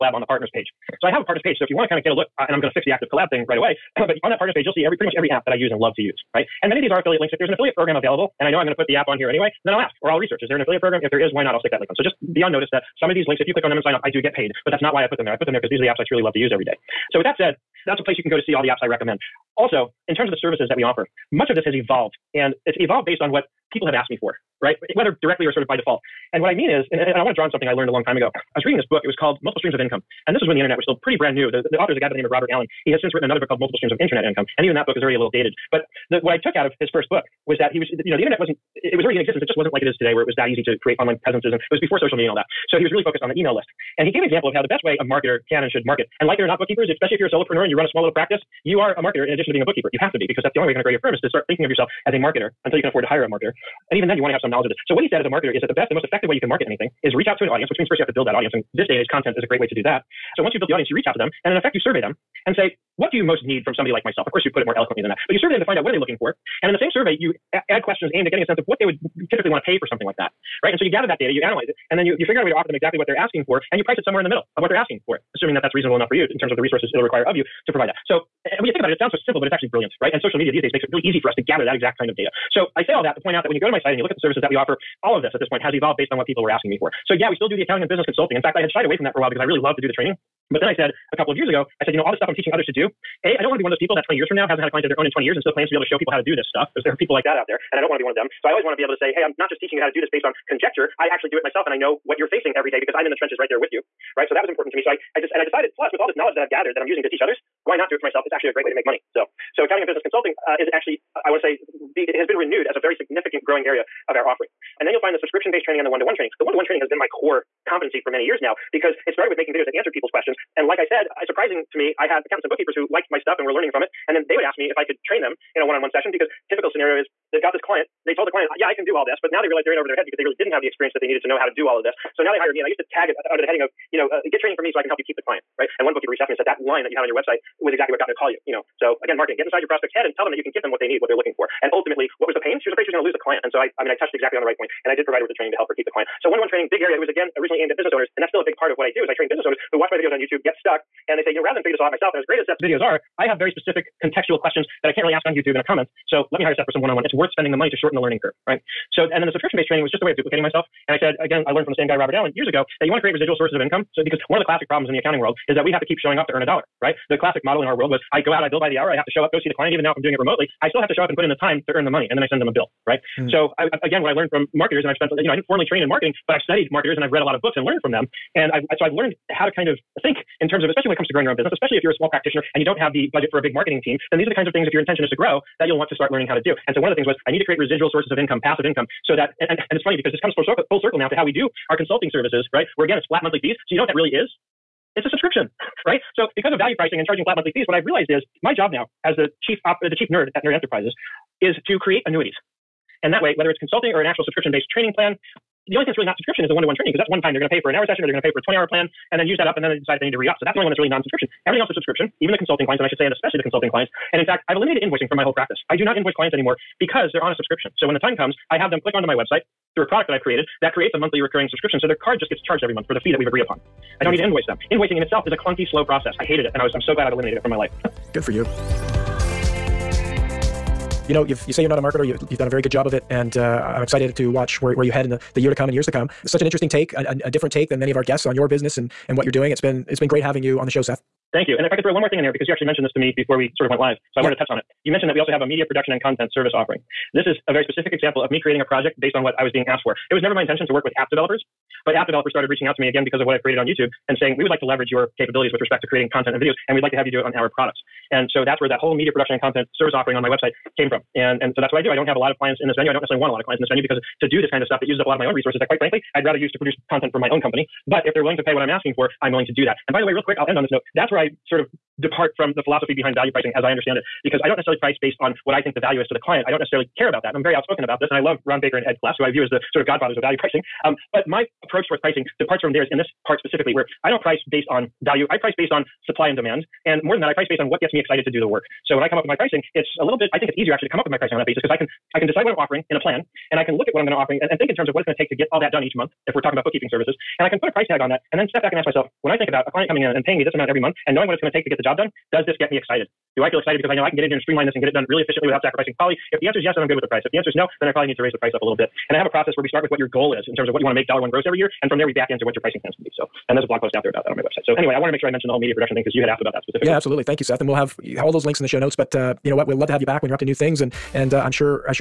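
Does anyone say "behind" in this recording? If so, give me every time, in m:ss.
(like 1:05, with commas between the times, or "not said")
4:32.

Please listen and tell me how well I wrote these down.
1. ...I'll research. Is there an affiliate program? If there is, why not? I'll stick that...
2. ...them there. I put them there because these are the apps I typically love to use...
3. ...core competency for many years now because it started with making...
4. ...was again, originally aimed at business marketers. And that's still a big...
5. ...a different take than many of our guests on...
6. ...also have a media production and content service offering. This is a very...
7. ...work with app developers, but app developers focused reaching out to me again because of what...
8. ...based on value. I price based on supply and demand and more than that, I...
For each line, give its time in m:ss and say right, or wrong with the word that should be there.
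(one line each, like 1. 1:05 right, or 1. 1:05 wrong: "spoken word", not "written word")
1. 0:10 right
2. 0:15 wrong: "truly", not "typically"
3. 1:57 right
4. 2:27 wrong: "owners", not "marketers"
5. 3:57 right
6. 4:05 right
7. 4:10 wrong: "started", not "focused"
8. 4:44 right.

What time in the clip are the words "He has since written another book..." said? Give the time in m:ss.
0:32.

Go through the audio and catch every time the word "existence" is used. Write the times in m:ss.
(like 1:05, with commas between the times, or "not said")
0:39.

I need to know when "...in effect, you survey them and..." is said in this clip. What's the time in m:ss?
1:01.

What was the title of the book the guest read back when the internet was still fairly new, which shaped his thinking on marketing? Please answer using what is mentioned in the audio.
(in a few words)
Multiple Streams of Income.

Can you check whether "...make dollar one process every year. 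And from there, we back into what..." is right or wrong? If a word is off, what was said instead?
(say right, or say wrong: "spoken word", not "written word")
wrong: "gross", not "process".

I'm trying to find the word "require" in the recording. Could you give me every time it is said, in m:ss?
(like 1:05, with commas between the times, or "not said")
1:17.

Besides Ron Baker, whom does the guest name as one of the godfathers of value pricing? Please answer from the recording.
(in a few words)
Ed Kless.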